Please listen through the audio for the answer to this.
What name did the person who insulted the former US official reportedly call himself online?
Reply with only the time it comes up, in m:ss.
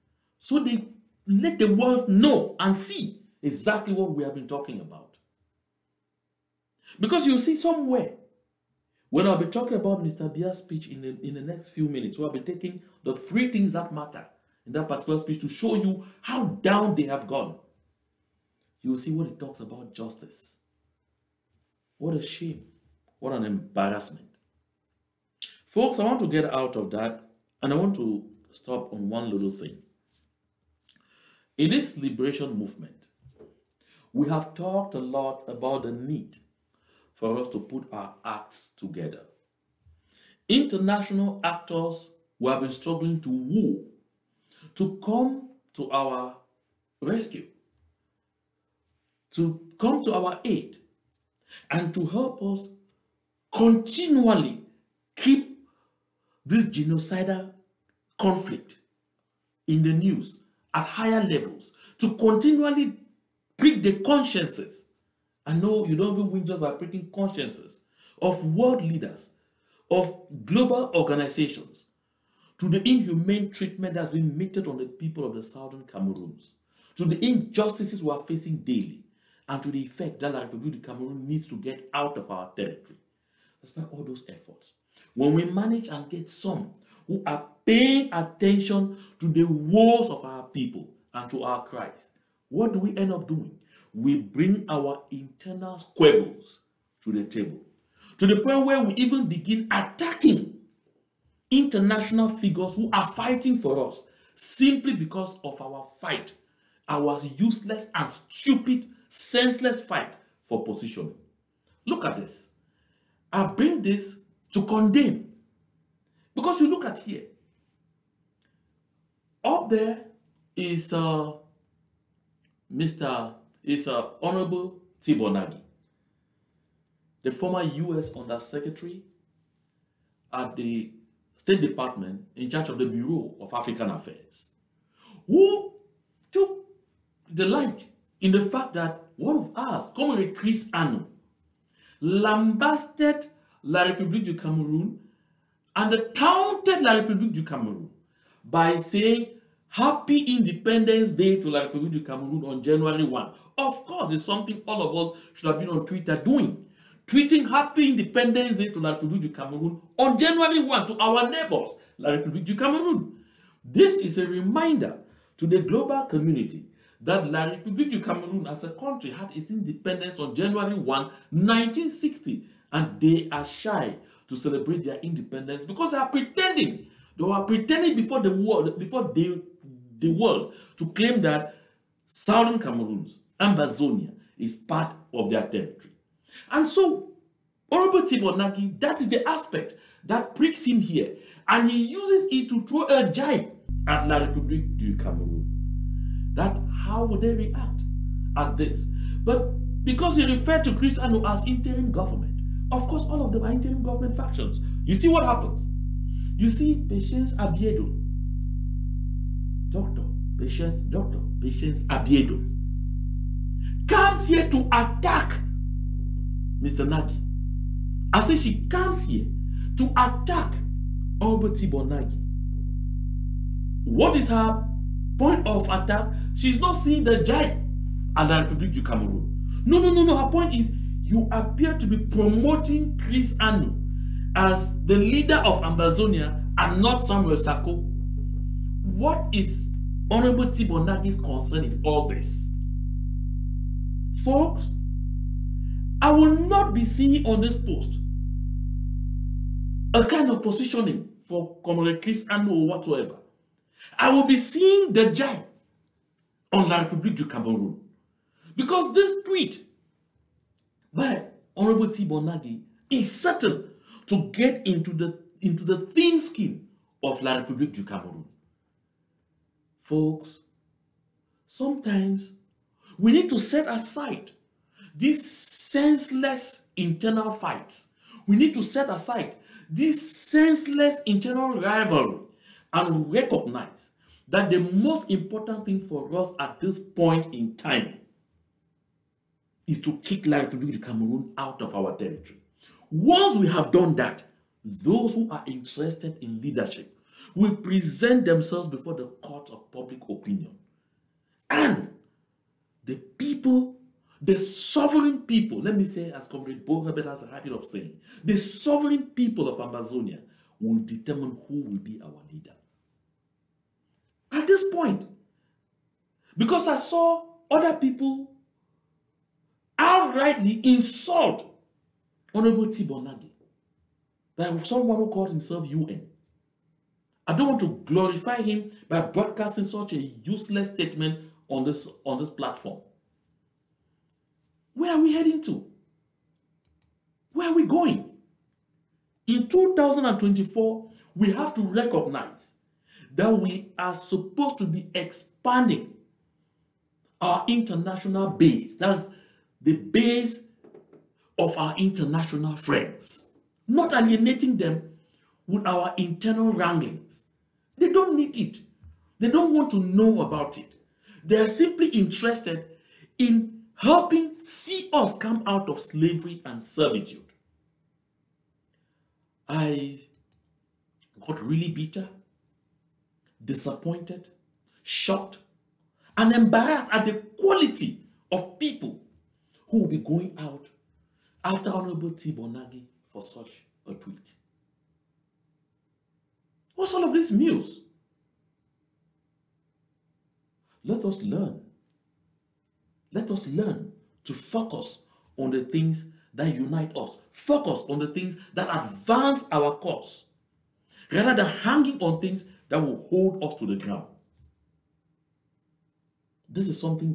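5:25.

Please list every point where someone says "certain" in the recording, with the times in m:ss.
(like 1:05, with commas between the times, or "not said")
4:23.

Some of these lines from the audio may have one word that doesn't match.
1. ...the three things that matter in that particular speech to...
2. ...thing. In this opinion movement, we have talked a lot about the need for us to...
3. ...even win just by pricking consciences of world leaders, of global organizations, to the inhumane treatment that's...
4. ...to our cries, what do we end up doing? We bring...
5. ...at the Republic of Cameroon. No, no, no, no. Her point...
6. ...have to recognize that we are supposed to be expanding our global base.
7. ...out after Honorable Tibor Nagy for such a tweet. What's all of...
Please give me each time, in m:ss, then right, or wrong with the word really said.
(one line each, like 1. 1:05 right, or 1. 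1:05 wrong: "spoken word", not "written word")
1. 0:13 right
2. 0:29 wrong: "liberation", not "opinion"
3. 1:06 right
4. 1:31 right
5. 3:48 right
6. 5:41 wrong: "international", not "global"
7. 6:20 right.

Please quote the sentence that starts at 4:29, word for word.
Folks, sometimes we need to set aside these senseless internal fights.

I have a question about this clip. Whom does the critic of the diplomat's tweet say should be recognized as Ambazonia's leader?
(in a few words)
Samuel Sako.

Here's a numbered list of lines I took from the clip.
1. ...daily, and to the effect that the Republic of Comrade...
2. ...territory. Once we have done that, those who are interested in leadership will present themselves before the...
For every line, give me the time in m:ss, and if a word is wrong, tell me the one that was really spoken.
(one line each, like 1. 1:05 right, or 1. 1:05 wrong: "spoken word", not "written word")
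1. 1:18 wrong: "Cameroon", not "Comrade"
2. 4:51 right.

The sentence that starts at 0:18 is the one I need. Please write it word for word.
You'll see what it talks about justice.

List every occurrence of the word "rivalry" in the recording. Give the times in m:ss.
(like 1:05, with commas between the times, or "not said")
4:41.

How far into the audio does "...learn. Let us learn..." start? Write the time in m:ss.
6:31.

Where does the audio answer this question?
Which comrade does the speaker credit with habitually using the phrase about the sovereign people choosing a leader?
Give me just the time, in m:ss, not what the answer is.
5:06.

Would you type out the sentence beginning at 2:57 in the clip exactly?
They were pretending before the world, before the, the world, to claim that southern Cameroons, Ambazonia, is part of their territory.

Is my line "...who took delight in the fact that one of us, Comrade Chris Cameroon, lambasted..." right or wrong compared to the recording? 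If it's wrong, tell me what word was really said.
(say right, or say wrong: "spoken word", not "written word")
wrong: "Anu", not "Cameroon".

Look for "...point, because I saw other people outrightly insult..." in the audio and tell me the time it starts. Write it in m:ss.
5:14.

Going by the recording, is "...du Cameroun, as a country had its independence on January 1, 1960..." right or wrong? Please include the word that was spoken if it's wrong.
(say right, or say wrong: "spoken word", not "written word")
right.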